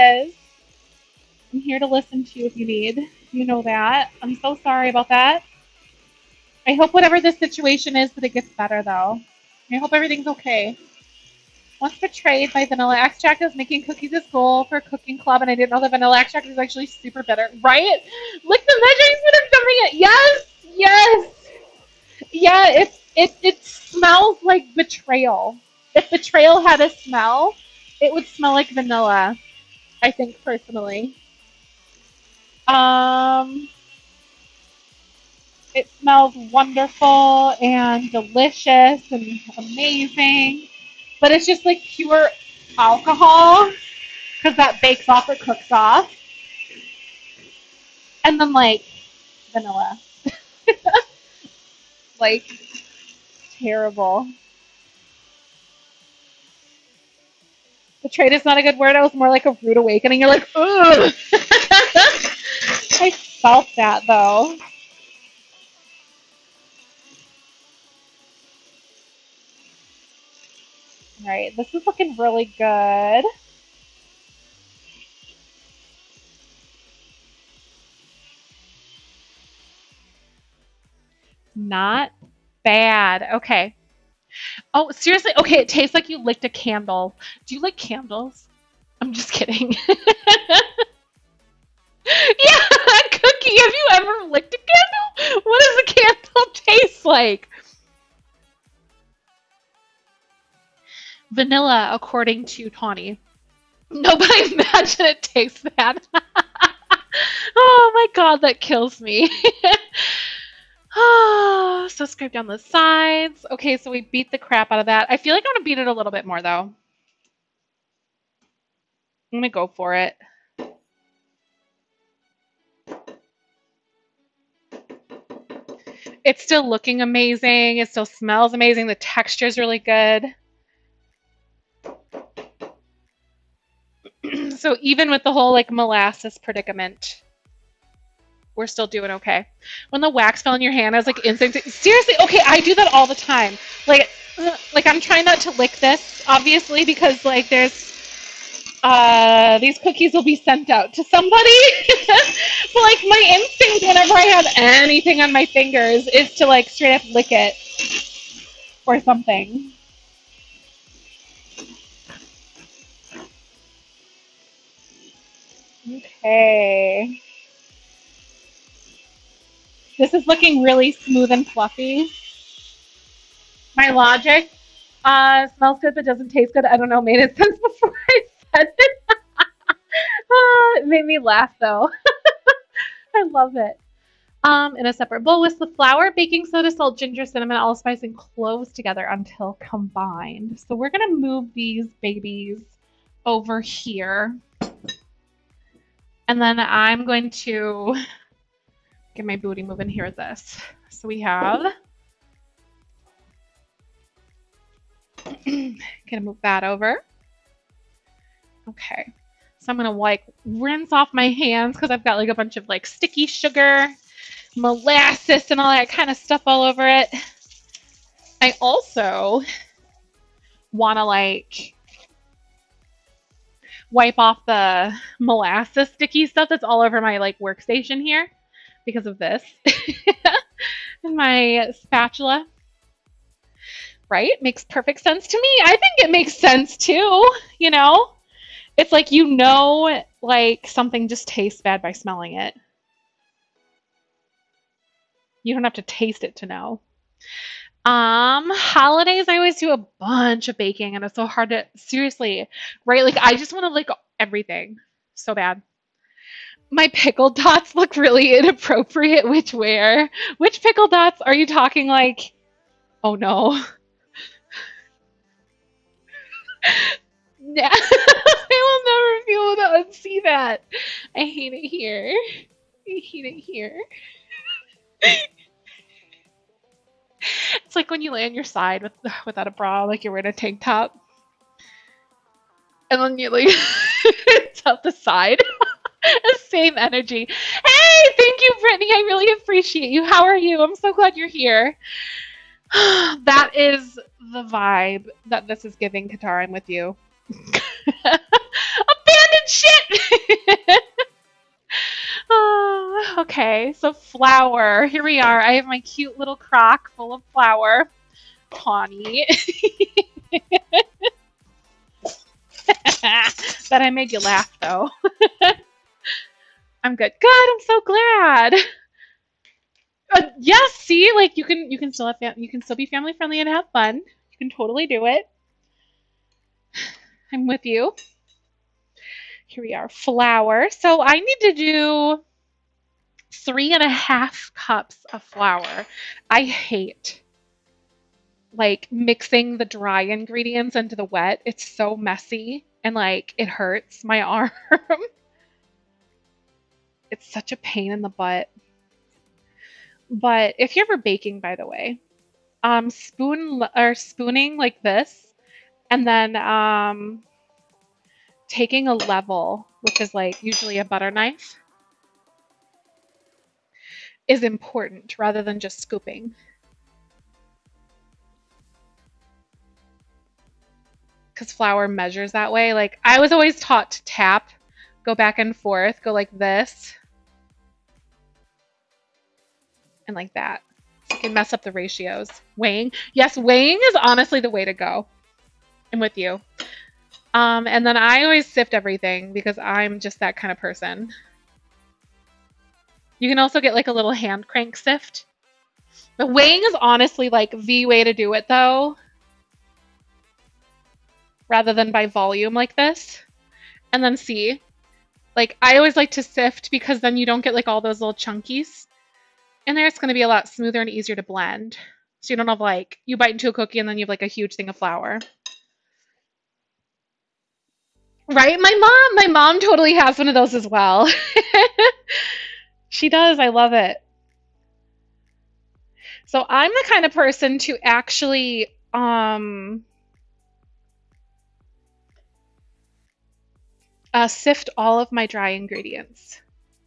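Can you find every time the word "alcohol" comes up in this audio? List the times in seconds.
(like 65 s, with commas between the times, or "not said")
42 s.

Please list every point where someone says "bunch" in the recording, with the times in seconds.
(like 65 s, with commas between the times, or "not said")
212 s, 249 s.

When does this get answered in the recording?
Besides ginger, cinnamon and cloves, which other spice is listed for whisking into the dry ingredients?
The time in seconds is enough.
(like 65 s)
187 s.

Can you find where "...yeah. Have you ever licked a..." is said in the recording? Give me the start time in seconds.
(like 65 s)
92 s.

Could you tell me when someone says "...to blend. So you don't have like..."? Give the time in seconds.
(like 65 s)
411 s.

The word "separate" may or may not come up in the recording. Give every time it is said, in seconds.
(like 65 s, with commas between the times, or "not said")
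184 s.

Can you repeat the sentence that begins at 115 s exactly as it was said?
I feel like I'm going to beat it a little bit more, though.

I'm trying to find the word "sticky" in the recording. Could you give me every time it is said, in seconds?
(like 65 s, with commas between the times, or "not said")
212 s, 225 s.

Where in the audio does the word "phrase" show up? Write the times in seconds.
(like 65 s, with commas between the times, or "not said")
not said.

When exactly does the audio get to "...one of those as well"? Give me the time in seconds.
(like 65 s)
420 s.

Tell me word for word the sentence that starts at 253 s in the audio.
Like, I just want to like everything so bad.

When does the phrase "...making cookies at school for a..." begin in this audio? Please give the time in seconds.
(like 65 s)
13 s.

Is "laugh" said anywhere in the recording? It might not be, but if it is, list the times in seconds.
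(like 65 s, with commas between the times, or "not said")
181 s, 314 s.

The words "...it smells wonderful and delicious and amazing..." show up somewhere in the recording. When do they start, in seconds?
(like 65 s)
35 s.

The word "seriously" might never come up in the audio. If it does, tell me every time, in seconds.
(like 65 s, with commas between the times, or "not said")
84 s, 141 s, 251 s.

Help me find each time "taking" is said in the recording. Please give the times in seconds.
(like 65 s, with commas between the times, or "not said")
358 s.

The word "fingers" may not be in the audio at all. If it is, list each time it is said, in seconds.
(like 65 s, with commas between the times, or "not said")
155 s.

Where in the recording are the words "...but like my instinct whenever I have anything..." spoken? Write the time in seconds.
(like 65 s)
152 s.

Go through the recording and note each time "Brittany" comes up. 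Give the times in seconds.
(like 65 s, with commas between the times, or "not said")
288 s.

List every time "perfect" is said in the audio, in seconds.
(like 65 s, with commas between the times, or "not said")
234 s.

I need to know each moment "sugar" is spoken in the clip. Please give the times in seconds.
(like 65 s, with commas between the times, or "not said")
213 s.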